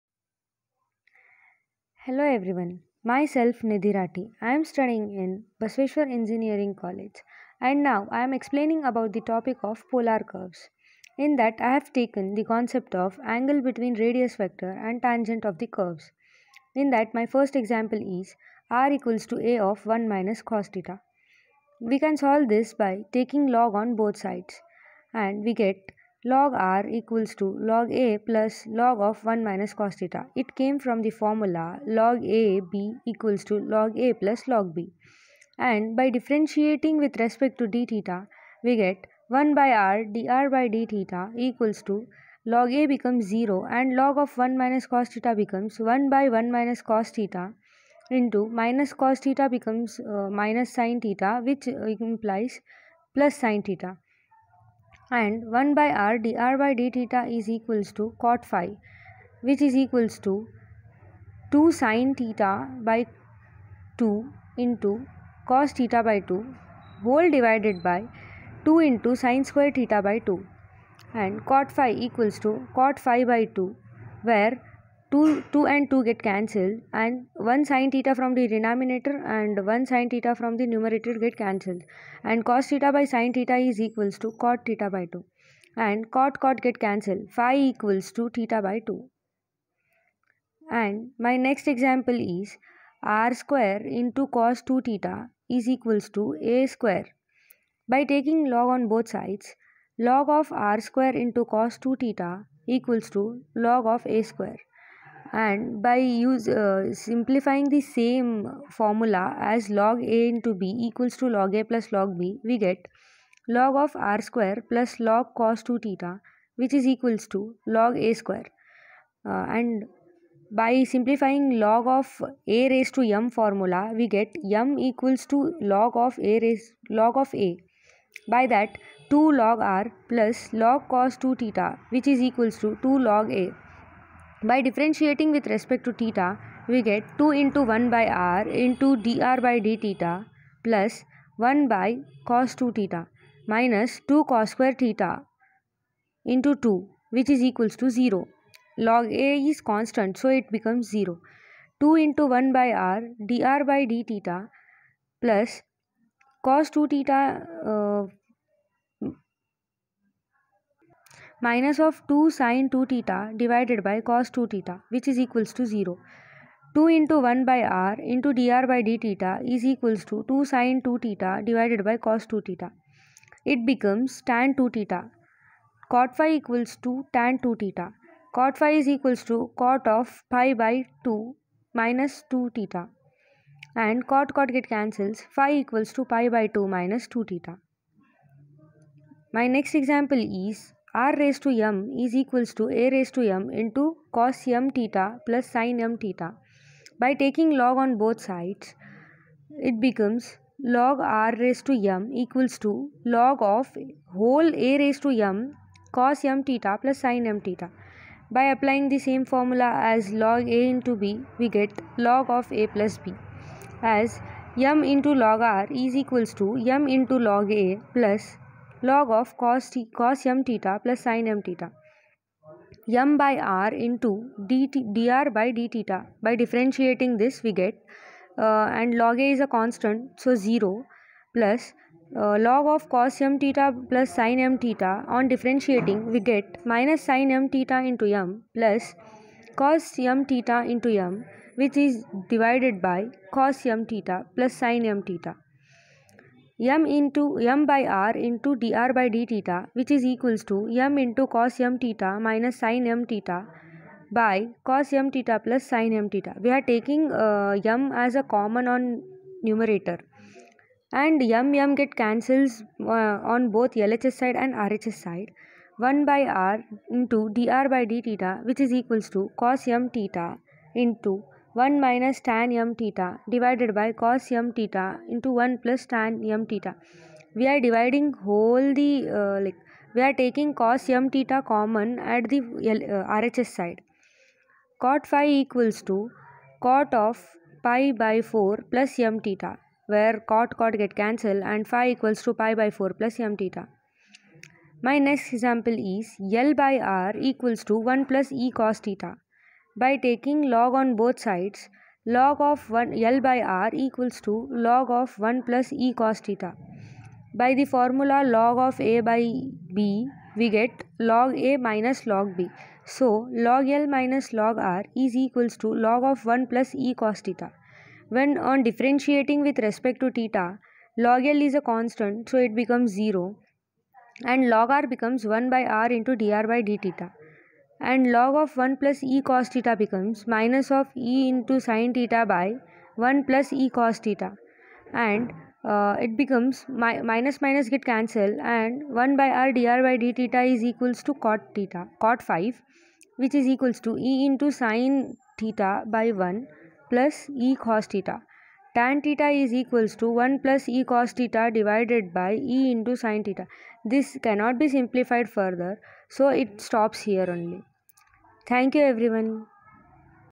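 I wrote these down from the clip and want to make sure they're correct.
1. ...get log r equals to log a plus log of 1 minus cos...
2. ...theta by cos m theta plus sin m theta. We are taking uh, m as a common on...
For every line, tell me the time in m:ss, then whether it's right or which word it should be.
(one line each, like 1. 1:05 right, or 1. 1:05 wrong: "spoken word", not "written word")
1. 0:25 right
2. 4:13 right.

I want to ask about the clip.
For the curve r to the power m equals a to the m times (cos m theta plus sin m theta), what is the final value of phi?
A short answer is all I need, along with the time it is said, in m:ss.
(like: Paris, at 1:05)
pi by 4 plus m theta, at 4:51.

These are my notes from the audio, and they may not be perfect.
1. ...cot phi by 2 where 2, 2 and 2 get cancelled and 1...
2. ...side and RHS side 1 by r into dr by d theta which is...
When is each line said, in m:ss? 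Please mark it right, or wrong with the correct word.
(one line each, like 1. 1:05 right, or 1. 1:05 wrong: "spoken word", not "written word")
1. 1:12 right
2. 4:24 right.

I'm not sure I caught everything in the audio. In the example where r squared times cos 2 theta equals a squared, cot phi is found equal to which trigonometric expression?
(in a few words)
tan 2 theta.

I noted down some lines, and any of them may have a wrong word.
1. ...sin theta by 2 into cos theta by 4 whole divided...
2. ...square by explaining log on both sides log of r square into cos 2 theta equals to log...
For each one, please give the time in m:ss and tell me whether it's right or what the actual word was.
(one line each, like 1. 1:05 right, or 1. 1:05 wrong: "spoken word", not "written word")
1. 1:01 wrong: "2", not "4"
2. 1:36 wrong: "taking", not "explaining".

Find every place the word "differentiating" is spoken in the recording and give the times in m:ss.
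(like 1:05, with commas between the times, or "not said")
0:36, 2:14, 3:46, 3:55, 5:18.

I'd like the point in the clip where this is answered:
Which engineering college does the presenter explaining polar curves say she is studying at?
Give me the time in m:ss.
0:05.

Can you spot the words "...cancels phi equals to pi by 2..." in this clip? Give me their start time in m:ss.
3:04.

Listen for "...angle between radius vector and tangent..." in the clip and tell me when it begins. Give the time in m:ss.
0:13.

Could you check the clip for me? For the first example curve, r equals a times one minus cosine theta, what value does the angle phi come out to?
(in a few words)
theta by 2.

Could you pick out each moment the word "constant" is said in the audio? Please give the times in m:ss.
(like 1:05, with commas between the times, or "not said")
2:29, 3:49, 5:21.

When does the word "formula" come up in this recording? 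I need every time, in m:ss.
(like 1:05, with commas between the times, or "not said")
0:31, 1:48, 2:03, 3:29, 5:07.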